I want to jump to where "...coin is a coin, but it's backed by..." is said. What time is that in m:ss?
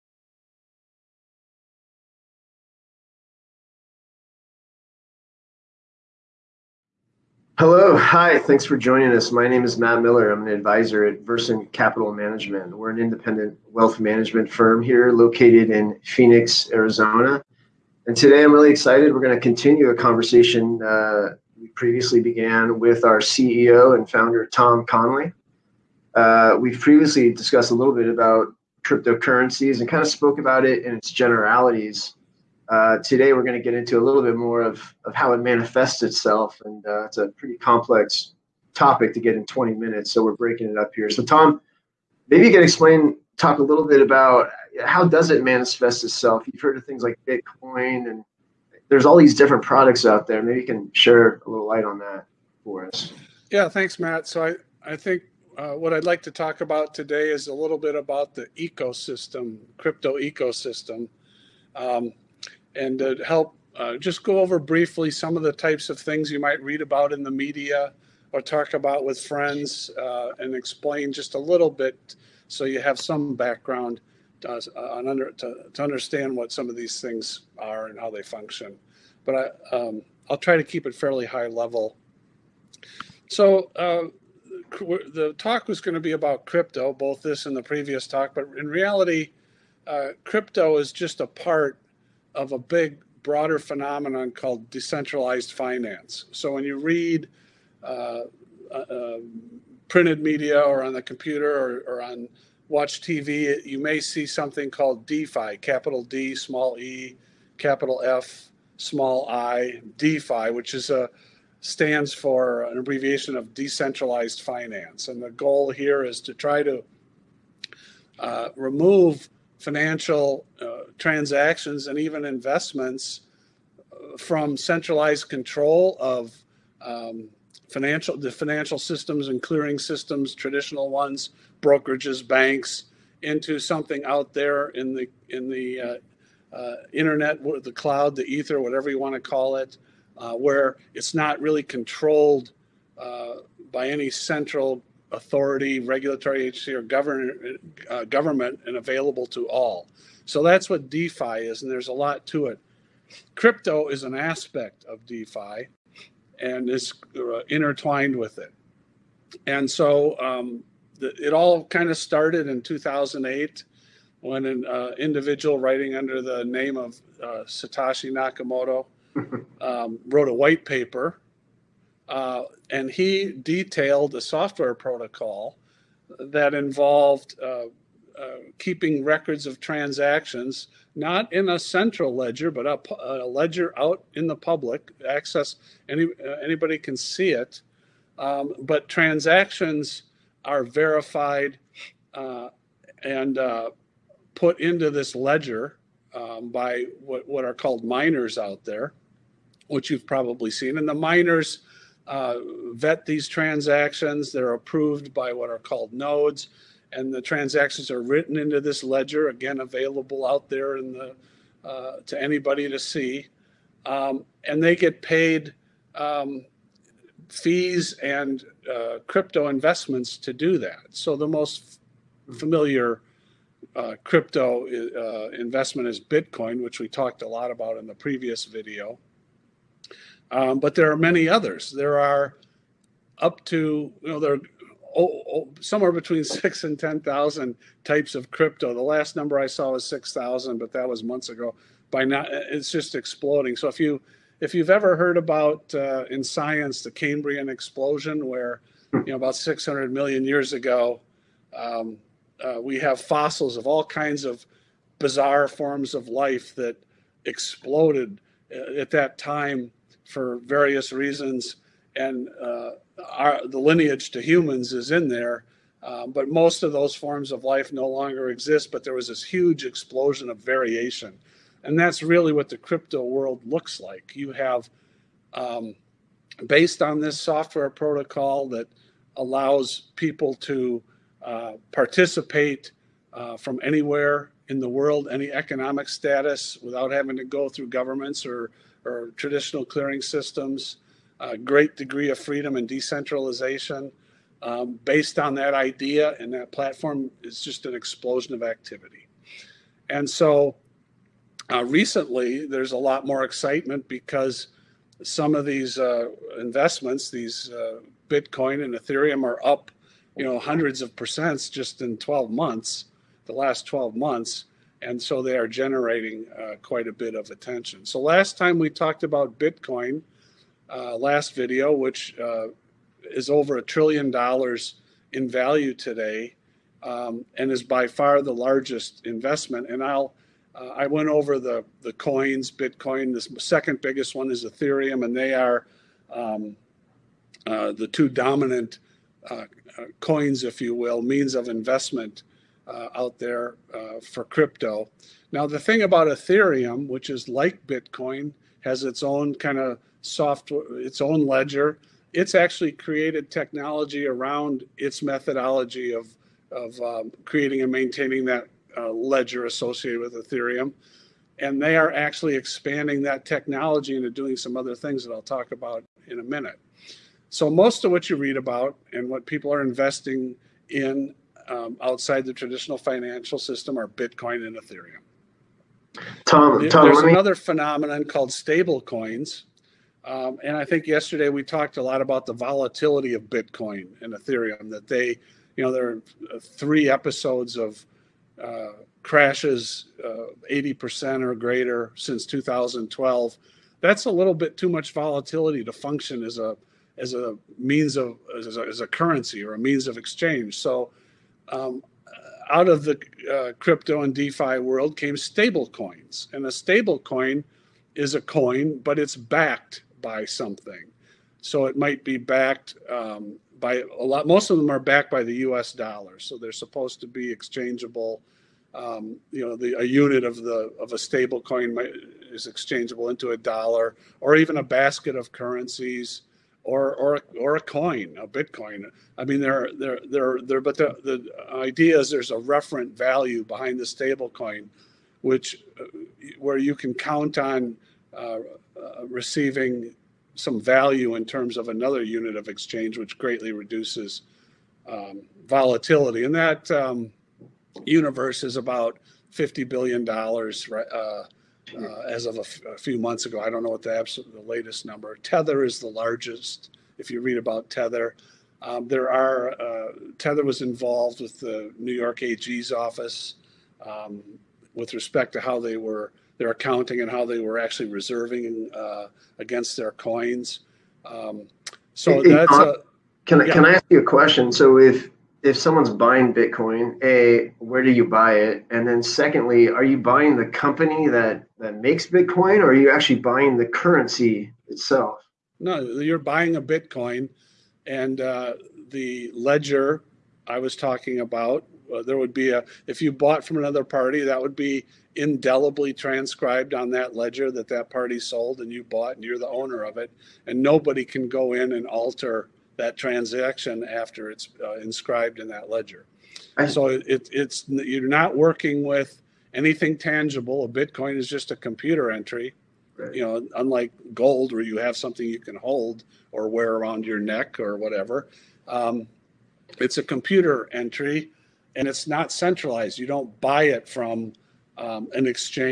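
6:46.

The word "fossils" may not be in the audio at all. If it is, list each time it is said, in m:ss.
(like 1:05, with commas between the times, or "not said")
4:12.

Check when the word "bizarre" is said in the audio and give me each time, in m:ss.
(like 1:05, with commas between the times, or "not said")
4:14.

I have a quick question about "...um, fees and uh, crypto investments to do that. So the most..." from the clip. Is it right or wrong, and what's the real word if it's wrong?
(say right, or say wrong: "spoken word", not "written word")
right.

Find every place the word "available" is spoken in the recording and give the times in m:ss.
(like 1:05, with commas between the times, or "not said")
2:28, 3:29.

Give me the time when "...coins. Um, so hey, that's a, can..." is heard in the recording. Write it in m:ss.
7:49.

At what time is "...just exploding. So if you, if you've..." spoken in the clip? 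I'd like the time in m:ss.
4:02.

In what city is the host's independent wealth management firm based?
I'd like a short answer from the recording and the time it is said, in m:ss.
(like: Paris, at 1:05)
Phoenix, Arizona, at 0:16.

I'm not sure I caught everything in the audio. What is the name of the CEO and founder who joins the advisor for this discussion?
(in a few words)
Tom Connelly.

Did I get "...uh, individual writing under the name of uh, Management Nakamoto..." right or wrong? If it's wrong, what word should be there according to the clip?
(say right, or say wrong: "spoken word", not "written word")
wrong: "Satoshi", not "Management".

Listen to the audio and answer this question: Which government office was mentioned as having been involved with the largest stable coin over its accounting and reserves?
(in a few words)
New York AG's office.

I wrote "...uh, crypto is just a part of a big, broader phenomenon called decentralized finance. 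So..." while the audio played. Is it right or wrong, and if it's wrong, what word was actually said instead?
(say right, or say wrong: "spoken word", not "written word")
right.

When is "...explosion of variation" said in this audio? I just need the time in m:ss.
4:29.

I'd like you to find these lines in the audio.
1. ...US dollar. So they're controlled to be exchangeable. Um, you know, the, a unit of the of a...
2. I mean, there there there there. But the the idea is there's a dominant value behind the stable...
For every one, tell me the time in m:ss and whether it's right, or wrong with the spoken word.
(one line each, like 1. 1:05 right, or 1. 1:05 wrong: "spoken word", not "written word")
1. 6:55 wrong: "supposed", not "controlled"
2. 7:09 wrong: "referent", not "dominant".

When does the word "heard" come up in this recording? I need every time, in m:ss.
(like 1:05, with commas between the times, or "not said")
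0:46, 4:04.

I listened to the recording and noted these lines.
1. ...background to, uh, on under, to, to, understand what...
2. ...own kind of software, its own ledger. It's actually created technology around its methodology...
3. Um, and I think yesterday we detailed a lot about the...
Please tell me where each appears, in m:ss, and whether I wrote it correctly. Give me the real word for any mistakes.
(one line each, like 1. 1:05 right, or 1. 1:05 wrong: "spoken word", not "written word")
1. 1:13 right
2. 5:49 right
3. 6:20 wrong: "talked", not "detailed".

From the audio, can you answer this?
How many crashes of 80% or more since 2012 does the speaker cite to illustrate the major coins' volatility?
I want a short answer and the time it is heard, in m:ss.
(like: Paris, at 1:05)
3, at 6:26.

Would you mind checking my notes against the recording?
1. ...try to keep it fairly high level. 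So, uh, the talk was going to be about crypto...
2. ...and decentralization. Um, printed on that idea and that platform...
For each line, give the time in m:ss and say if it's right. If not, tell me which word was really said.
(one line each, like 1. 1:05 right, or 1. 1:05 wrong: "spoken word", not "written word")
1. 1:20 right
2. 4:52 wrong: "based", not "printed".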